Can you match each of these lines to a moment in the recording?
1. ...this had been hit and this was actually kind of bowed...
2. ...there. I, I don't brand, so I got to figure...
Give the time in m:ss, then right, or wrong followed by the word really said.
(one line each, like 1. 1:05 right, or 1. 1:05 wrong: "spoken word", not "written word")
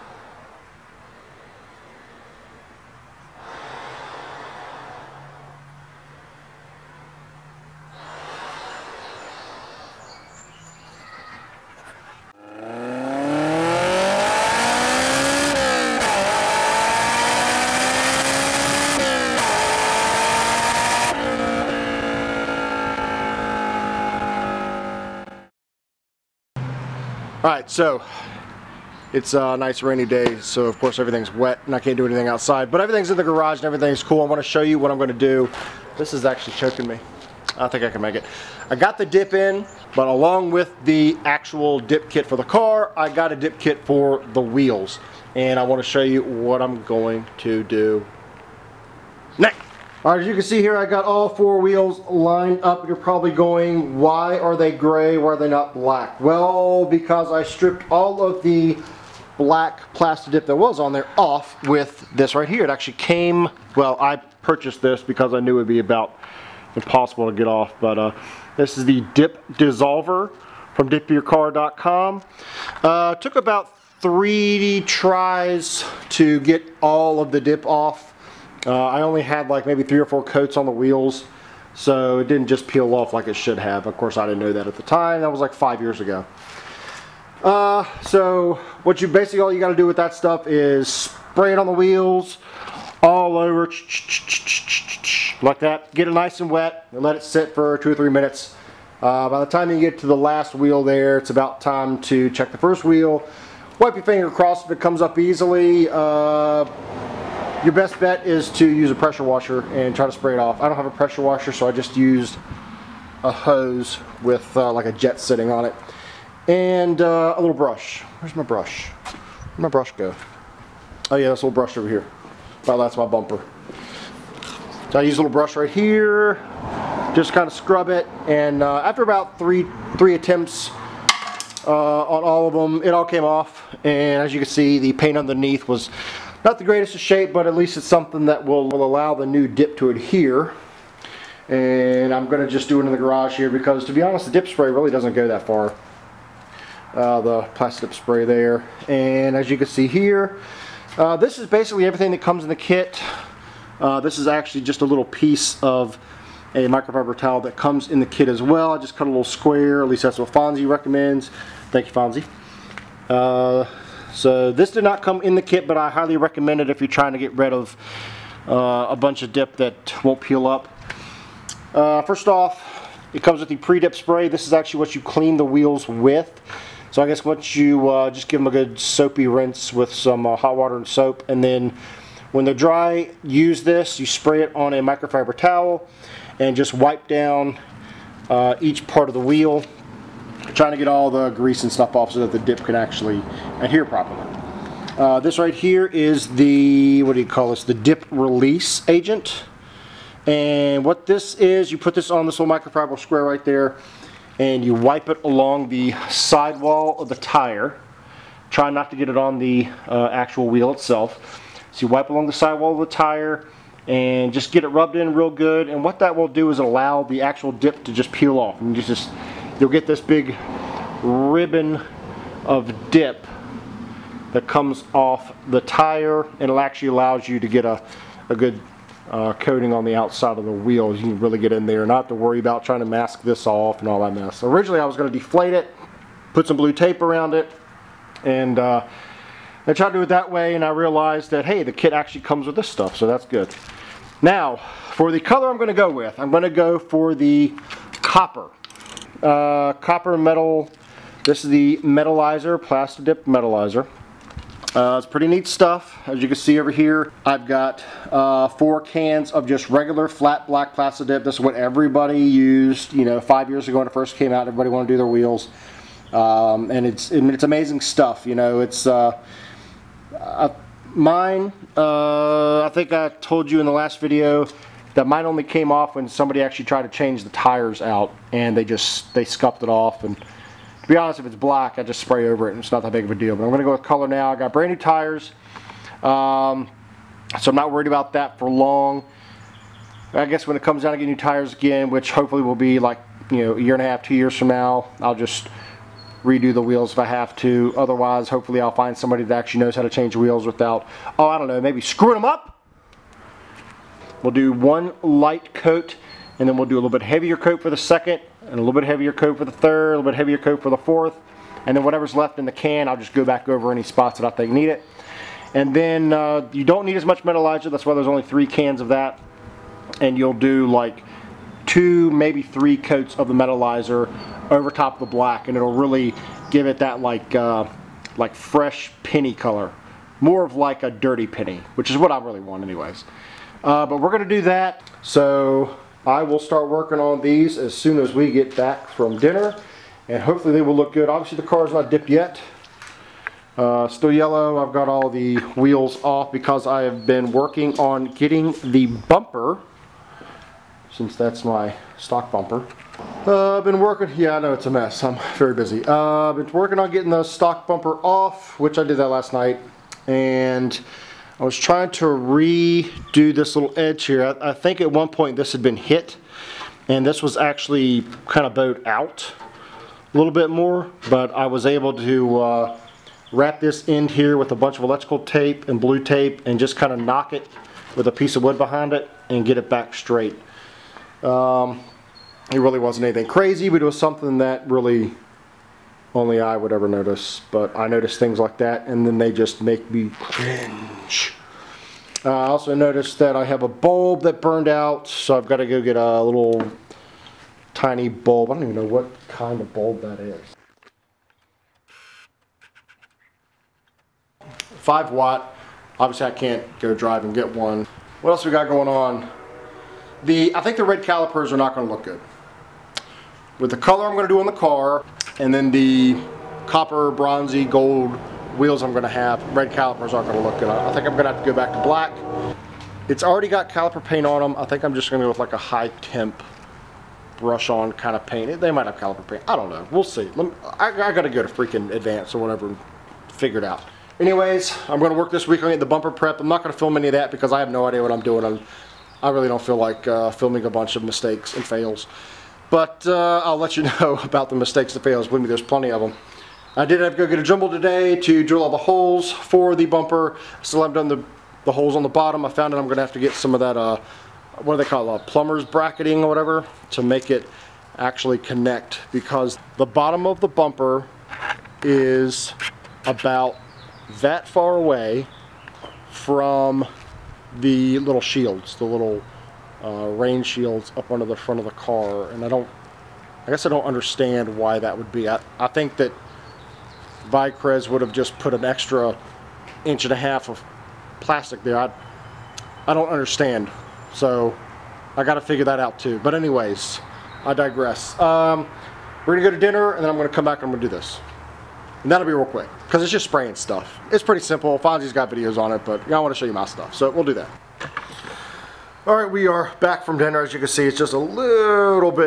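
1. 6:05 right
2. 8:01 wrong: "understand", not "brand".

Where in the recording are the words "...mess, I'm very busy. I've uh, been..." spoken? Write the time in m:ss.
5:54.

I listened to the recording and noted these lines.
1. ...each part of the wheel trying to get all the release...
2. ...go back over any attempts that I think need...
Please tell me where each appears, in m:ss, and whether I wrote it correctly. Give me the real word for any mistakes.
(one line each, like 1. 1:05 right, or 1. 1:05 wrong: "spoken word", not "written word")
1. 3:08 wrong: "grease", not "release"
2. 5:13 wrong: "spots", not "attempts".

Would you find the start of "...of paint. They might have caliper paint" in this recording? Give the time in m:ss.
7:08.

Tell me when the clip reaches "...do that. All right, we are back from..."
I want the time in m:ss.
8:17.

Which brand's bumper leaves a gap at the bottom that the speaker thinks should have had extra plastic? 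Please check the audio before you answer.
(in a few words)
Vicrez.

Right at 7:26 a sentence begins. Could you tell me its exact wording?
I did have to go get a jumble today to drill all the holes for the bumper.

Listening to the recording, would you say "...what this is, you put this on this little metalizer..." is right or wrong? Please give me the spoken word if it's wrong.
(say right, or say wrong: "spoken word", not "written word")
wrong: "microfiber", not "metalizer".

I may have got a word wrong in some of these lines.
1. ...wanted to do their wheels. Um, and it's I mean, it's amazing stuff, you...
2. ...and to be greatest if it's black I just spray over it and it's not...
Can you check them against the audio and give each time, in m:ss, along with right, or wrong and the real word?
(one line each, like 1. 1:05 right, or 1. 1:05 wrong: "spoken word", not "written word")
1. 4:24 right
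2. 4:40 wrong: "honest", not "greatest".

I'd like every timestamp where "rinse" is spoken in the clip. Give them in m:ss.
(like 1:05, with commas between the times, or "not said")
2:59.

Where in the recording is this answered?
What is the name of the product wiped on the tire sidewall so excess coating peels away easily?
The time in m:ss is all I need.
3:17.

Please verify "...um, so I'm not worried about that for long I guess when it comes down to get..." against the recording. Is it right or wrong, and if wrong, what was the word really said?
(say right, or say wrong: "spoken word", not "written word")
right.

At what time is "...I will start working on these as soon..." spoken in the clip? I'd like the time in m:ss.
5:36.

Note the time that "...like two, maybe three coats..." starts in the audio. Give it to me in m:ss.
5:20.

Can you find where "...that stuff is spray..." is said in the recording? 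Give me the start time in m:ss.
1:29.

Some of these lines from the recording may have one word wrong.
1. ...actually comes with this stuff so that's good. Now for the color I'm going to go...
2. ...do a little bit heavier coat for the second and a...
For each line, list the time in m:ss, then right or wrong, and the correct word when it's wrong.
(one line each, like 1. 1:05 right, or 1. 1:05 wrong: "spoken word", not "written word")
1. 4:01 right
2. 5:06 right.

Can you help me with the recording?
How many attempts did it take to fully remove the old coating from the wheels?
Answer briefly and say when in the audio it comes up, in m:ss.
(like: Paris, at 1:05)
3, at 1:14.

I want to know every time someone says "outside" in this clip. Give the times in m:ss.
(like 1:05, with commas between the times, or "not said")
0:32, 3:49.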